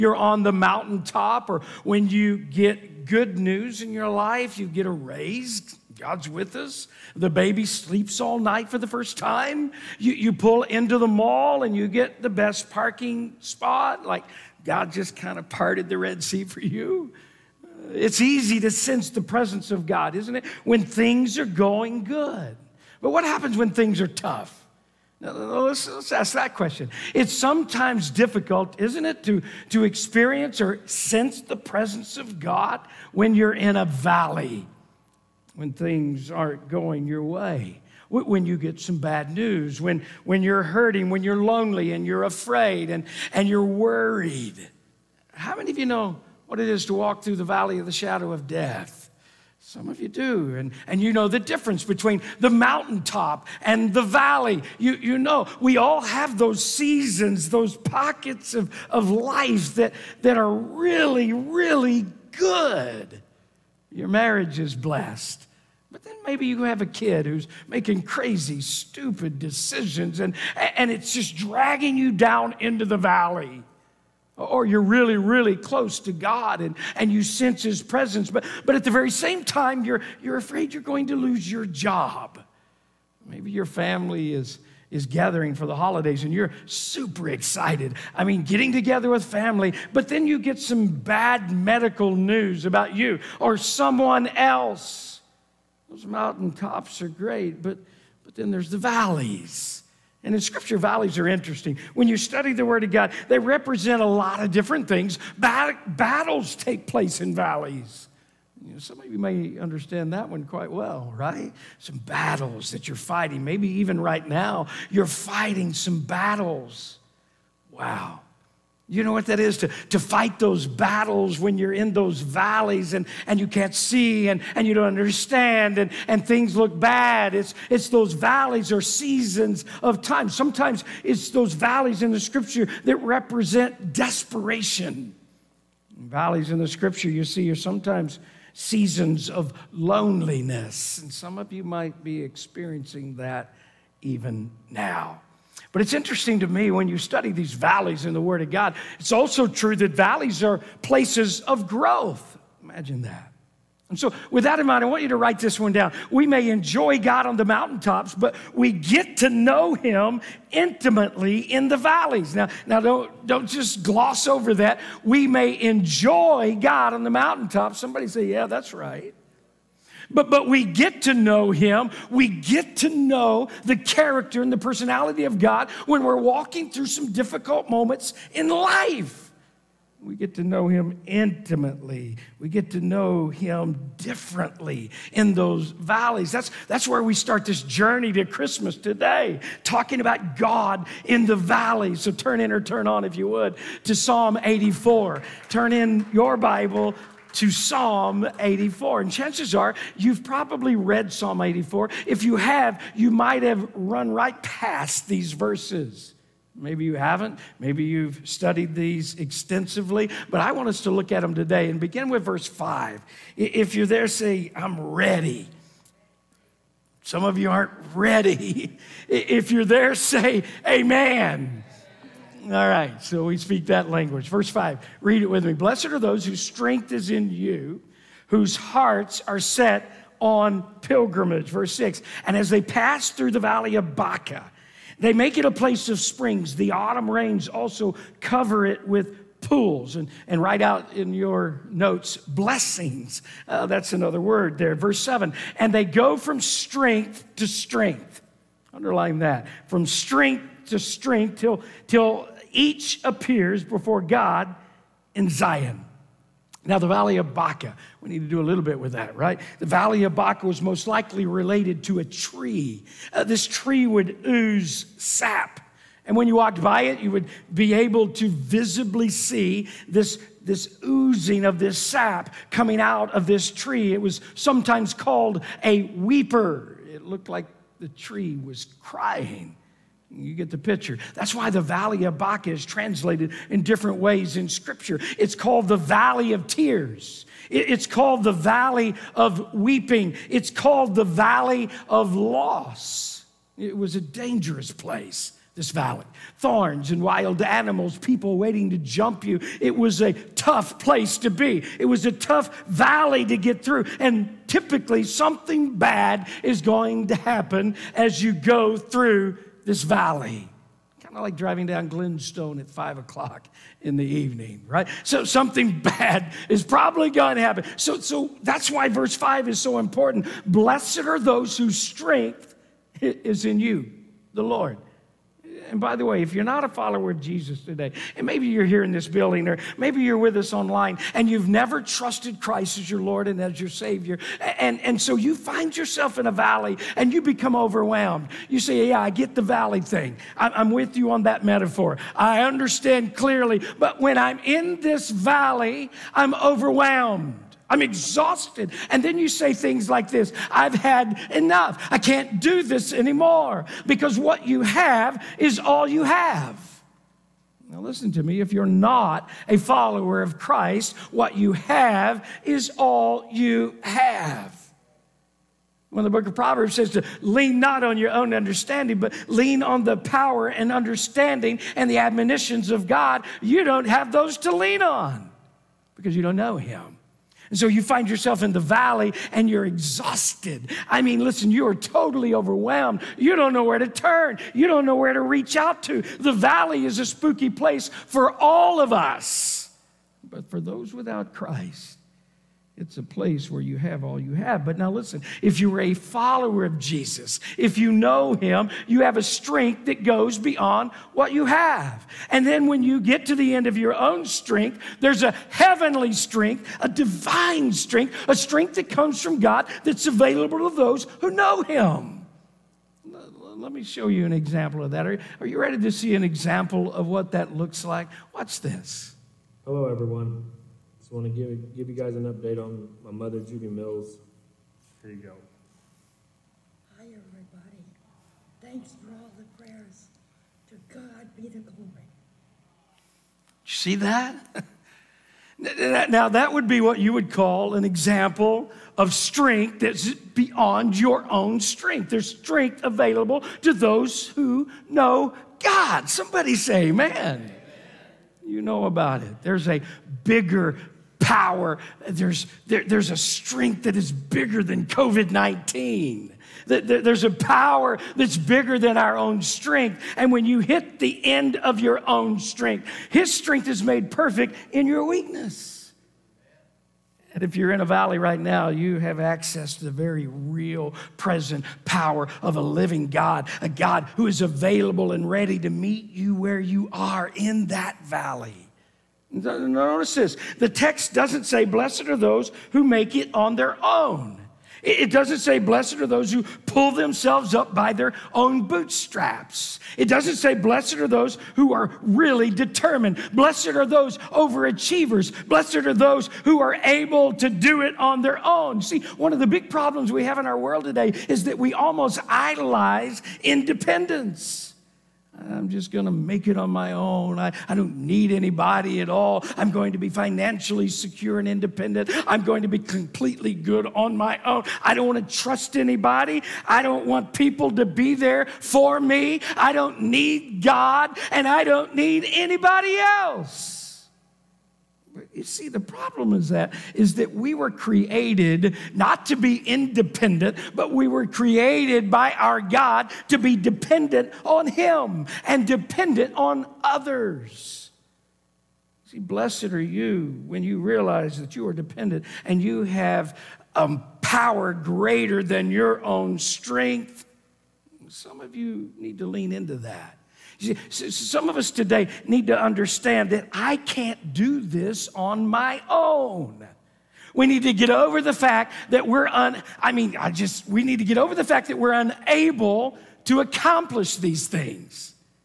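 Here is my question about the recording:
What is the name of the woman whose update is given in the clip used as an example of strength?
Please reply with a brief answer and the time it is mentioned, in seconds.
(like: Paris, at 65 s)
Judy Mills, at 423 s.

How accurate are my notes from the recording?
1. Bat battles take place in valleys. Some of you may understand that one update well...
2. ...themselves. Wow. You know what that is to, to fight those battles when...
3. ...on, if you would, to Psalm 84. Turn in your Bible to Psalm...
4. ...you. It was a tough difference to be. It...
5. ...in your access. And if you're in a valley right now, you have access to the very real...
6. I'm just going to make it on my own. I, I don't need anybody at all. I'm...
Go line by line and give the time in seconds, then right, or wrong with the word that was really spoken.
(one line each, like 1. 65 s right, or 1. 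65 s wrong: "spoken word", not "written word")
1. 105 s wrong: "quite", not "update"
2. 116 s wrong: "battles", not "themselves"
3. 192 s right
4. 299 s wrong: "place", not "difference"
5. 464 s wrong: "weakness", not "access"
6. 505 s right.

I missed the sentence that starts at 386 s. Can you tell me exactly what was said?
The valley is a spooky place for all of us.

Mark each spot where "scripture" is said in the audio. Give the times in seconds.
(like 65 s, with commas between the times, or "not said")
100 s, 132 s, 136 s, 284 s.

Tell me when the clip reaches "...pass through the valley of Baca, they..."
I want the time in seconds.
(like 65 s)
232 s.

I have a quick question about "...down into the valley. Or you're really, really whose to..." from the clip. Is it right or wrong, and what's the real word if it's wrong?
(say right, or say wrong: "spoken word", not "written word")
wrong: "close", not "whose".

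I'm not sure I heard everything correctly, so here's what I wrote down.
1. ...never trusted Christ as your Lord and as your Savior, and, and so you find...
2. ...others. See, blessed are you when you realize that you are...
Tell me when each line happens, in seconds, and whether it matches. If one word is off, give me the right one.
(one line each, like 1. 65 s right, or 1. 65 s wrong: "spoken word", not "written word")
1. 331 s right
2. 536 s right.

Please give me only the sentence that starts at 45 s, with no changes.
How many of you know what it is to walk through the valley of the shadow of death?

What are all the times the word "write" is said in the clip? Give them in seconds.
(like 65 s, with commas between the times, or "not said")
155 s, 240 s.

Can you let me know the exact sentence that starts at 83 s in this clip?
Maybe your family is is gathering for the holidays and you're super excited.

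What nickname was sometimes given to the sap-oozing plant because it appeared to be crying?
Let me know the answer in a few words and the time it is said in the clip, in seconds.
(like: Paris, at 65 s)
a weeper, at 275 s.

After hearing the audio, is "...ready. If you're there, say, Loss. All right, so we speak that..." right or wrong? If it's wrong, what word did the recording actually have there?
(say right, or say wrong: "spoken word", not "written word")
wrong: "Amen", not "Loss".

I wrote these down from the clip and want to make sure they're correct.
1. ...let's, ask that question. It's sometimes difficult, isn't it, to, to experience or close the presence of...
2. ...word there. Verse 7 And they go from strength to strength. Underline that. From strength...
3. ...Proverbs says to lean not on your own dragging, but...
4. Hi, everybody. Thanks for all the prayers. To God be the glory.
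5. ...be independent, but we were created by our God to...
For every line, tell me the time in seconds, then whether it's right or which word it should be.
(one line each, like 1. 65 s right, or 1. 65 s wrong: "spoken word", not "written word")
1. 25 s wrong: "sense", not "close"
2. 244 s right
3. 366 s wrong: "understanding", not "dragging"
4. 426 s right
5. 529 s right.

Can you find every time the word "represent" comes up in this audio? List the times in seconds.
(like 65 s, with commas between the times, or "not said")
103 s, 132 s.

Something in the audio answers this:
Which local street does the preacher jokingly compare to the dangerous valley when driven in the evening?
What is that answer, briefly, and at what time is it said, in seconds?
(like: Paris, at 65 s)
Glenstone, at 311 s.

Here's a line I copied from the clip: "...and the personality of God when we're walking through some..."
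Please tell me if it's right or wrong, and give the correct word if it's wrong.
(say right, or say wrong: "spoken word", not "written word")
right.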